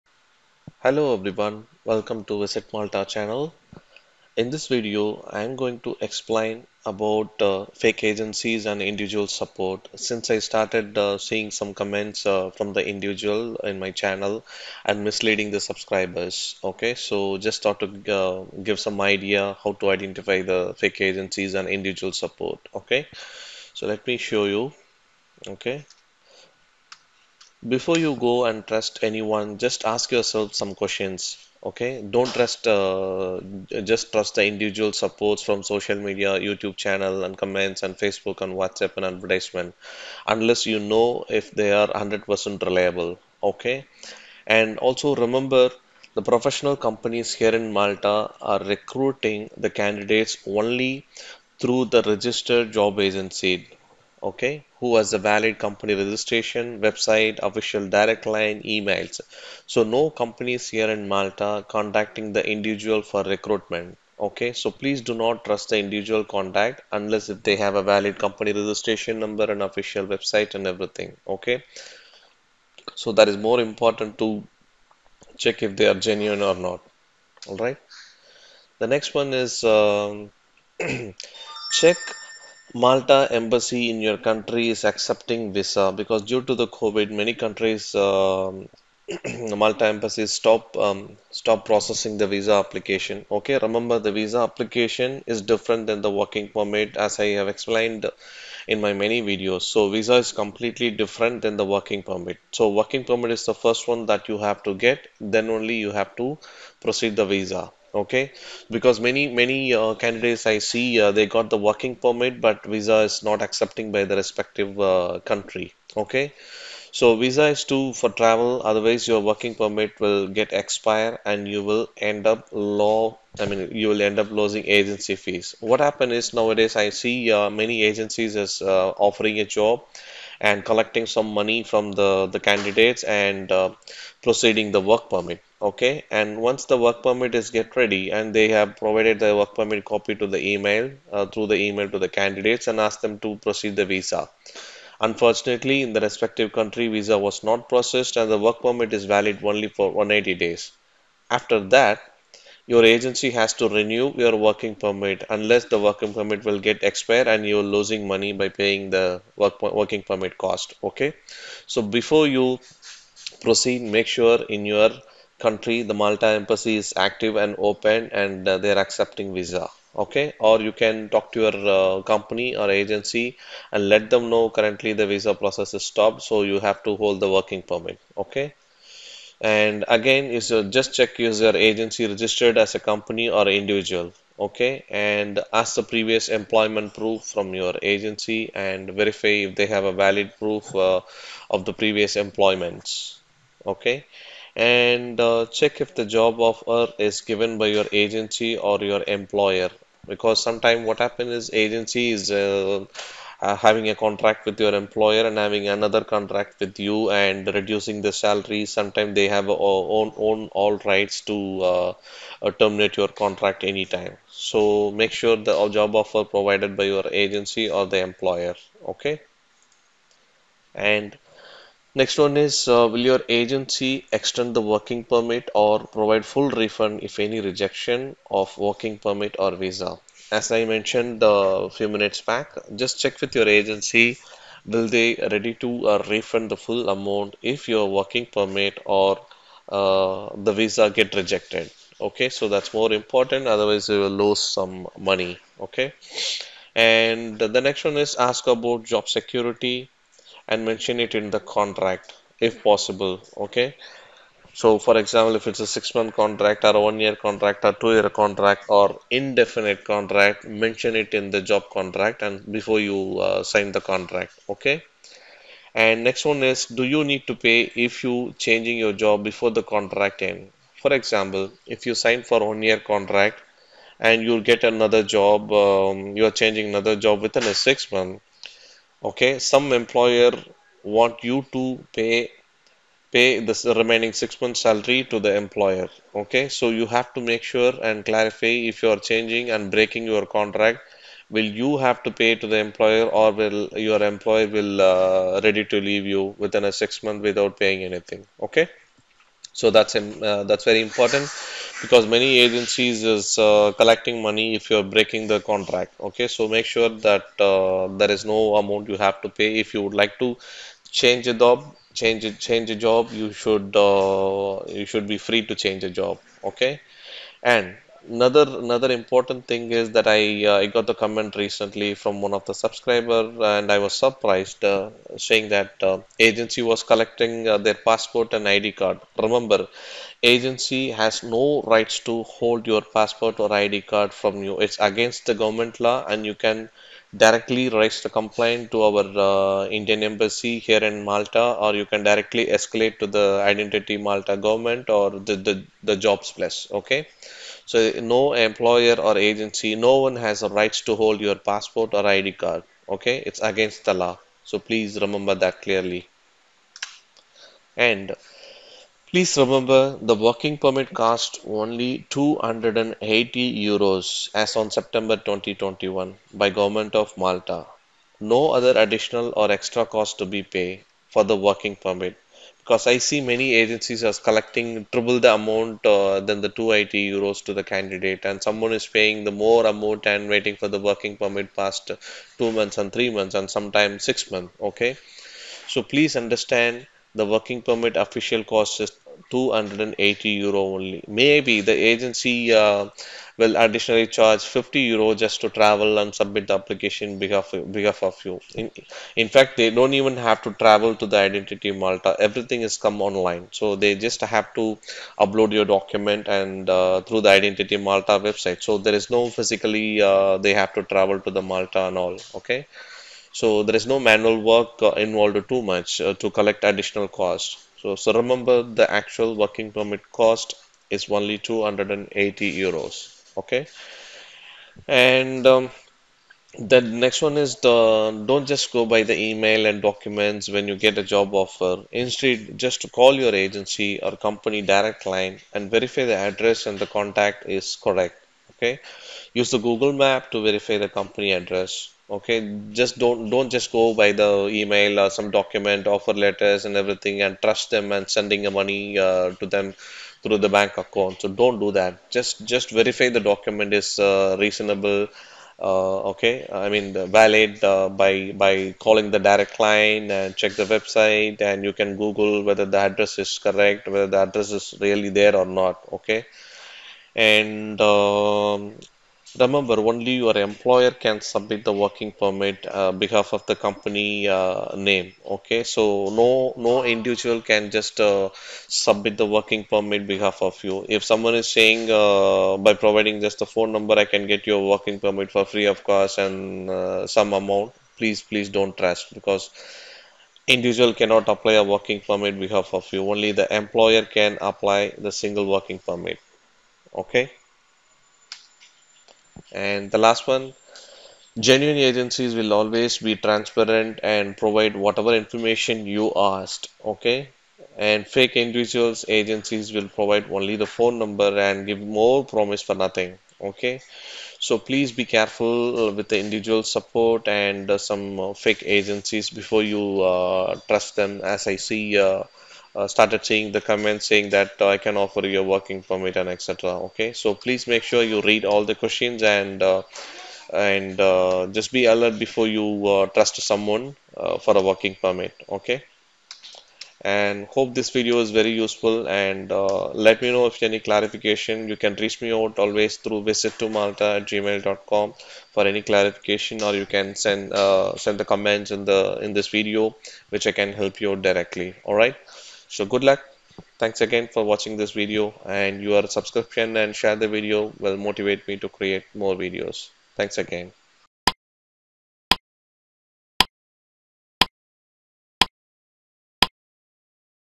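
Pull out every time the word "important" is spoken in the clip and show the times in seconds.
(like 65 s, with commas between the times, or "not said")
73 s, 242 s, 300 s, 318 s.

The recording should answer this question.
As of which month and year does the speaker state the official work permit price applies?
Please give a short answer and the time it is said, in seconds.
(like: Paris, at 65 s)
September 2021, at 364 s.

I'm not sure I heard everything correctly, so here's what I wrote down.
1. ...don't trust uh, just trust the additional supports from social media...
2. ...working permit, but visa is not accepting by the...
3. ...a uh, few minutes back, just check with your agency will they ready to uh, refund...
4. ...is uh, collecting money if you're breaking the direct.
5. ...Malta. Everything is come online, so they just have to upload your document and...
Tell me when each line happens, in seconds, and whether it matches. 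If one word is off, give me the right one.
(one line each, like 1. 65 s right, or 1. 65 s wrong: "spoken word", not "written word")
1. 32 s wrong: "individual", not "additional"
2. 111 s right
3. 231 s right
4. 303 s wrong: "contract", not "direct"
5. 401 s right.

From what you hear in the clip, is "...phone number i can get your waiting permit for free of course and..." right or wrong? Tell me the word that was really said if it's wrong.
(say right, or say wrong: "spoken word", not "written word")
wrong: "working", not "waiting".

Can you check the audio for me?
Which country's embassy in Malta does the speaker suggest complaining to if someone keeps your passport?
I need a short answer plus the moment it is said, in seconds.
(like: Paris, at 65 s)
Indian embassy, at 339 s.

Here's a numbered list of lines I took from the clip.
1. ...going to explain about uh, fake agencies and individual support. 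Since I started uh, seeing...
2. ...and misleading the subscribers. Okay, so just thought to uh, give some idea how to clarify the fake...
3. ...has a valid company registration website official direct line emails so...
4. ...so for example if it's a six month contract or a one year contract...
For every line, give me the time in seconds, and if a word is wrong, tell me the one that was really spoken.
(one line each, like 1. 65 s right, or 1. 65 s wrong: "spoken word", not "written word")
1. 5 s right
2. 14 s wrong: "identify", not "clarify"
3. 54 s right
4. 254 s right.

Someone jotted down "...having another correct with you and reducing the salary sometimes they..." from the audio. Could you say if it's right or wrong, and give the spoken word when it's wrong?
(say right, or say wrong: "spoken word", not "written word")
wrong: "contract", not "correct".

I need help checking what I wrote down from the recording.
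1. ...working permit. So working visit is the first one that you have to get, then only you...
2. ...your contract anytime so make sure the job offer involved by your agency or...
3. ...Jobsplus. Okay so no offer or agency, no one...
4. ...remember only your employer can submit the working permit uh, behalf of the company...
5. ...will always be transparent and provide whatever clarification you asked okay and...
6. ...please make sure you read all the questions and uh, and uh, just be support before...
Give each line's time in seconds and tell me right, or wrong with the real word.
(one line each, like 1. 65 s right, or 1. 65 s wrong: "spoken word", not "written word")
1. 101 s wrong: "permit", not "visit"
2. 212 s wrong: "provided", not "involved"
3. 345 s wrong: "employer", not "offer"
4. 469 s right
5. 502 s wrong: "information", not "clarification"
6. 527 s wrong: "alert", not "support".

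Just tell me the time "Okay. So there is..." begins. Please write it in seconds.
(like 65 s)
412 s.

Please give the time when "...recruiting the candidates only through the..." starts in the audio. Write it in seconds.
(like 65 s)
48 s.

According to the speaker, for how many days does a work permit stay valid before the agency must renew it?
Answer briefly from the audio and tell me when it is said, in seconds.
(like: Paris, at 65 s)
180 days, at 149 s.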